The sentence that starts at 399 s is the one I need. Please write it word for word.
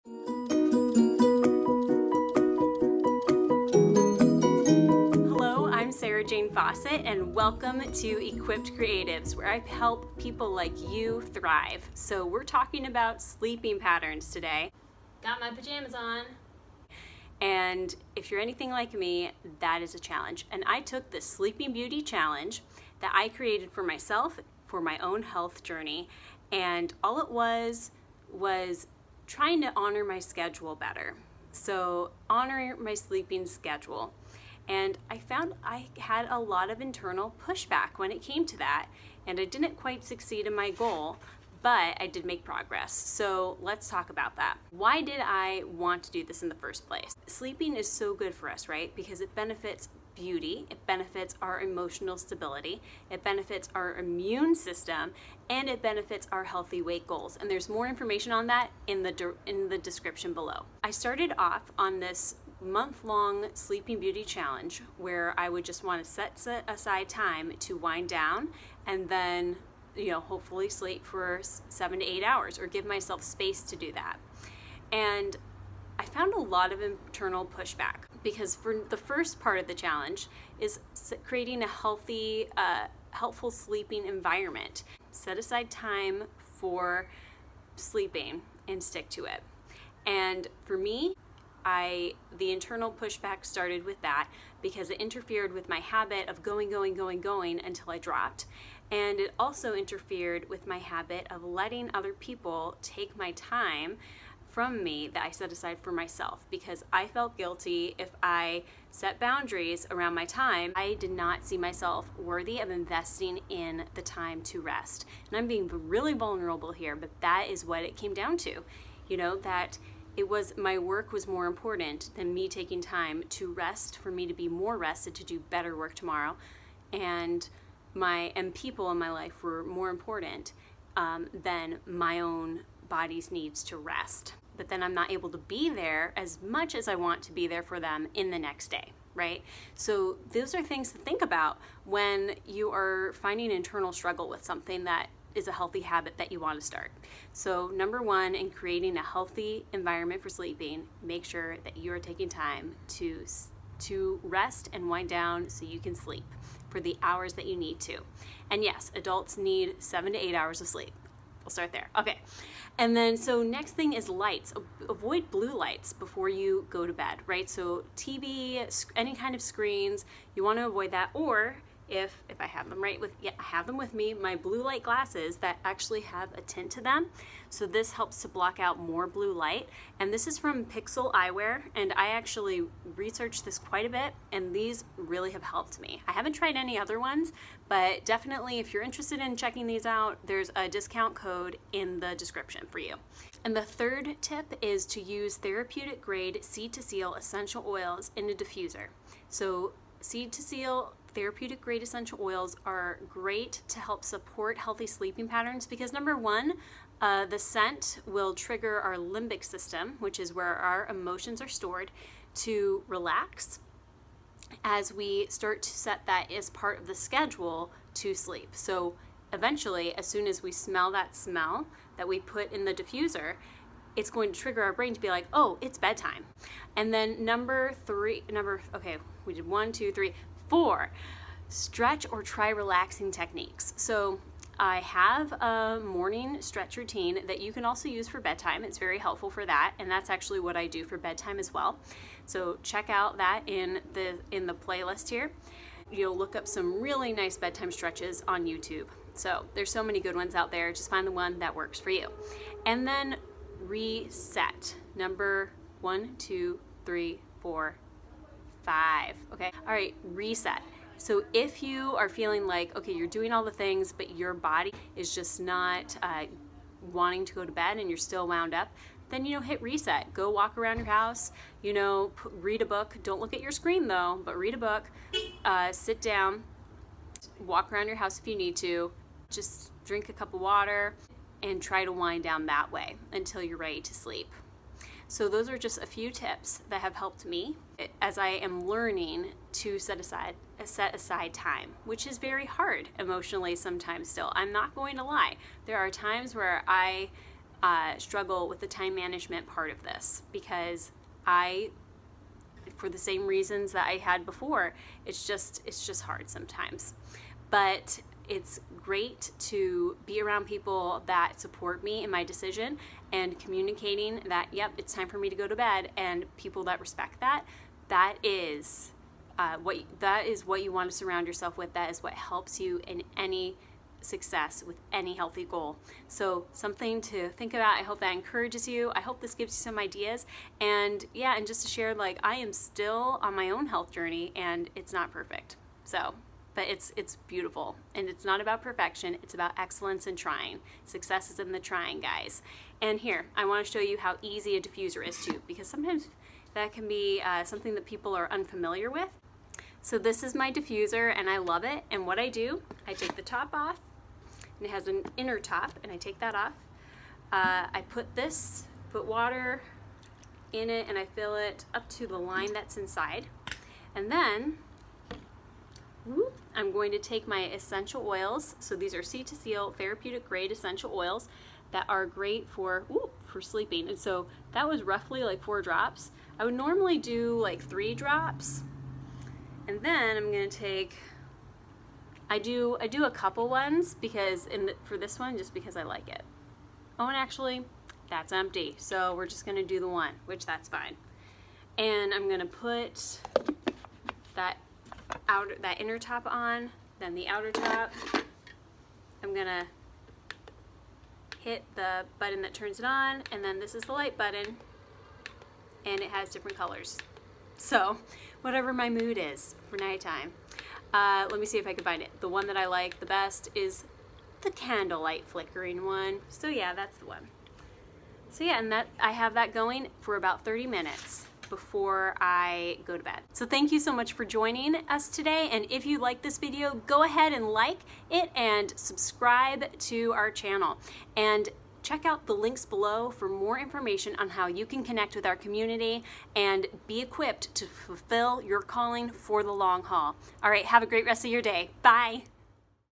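I'm gonna hit the button that turns it on, and then this is the light button, and it has different colors.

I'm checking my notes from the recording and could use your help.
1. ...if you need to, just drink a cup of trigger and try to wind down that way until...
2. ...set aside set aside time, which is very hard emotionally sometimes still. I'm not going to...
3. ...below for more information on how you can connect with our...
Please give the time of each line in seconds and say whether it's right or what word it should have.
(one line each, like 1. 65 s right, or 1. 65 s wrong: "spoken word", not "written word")
1. 278 s wrong: "water", not "trigger"
2. 289 s right
3. 432 s right.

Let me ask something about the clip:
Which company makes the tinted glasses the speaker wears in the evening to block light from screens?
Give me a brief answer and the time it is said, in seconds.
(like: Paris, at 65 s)
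Pixel Eyewear, at 180 s.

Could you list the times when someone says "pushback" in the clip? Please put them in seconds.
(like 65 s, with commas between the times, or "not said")
37 s, 77 s, 92 s.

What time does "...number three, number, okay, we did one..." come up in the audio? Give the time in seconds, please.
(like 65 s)
227 s.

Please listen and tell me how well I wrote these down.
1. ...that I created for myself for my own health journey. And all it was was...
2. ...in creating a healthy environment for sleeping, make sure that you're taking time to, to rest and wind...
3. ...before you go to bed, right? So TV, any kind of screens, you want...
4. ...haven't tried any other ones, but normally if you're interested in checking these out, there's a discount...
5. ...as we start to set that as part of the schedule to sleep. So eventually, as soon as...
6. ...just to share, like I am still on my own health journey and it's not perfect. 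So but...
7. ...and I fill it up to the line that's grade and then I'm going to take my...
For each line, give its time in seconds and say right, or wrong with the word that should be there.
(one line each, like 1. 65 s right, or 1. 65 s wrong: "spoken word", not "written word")
1. 22 s right
2. 148 s right
3. 165 s right
4. 186 s wrong: "definitely", not "normally"
5. 214 s right
6. 331 s right
7. 360 s wrong: "inside", not "grade".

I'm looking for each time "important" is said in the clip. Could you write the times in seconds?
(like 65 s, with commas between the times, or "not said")
121 s, 129 s.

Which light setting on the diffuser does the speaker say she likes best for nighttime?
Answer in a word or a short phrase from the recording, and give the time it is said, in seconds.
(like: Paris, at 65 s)
candlelight flickering, at 414 s.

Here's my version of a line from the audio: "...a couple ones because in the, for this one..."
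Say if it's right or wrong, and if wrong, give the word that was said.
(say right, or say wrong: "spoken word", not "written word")
right.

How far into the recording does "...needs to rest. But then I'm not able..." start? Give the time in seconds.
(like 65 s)
133 s.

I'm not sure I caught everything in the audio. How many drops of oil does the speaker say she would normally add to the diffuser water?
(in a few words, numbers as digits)
3 drops.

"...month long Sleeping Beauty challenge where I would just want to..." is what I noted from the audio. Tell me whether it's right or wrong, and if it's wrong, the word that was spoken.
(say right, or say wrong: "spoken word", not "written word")
right.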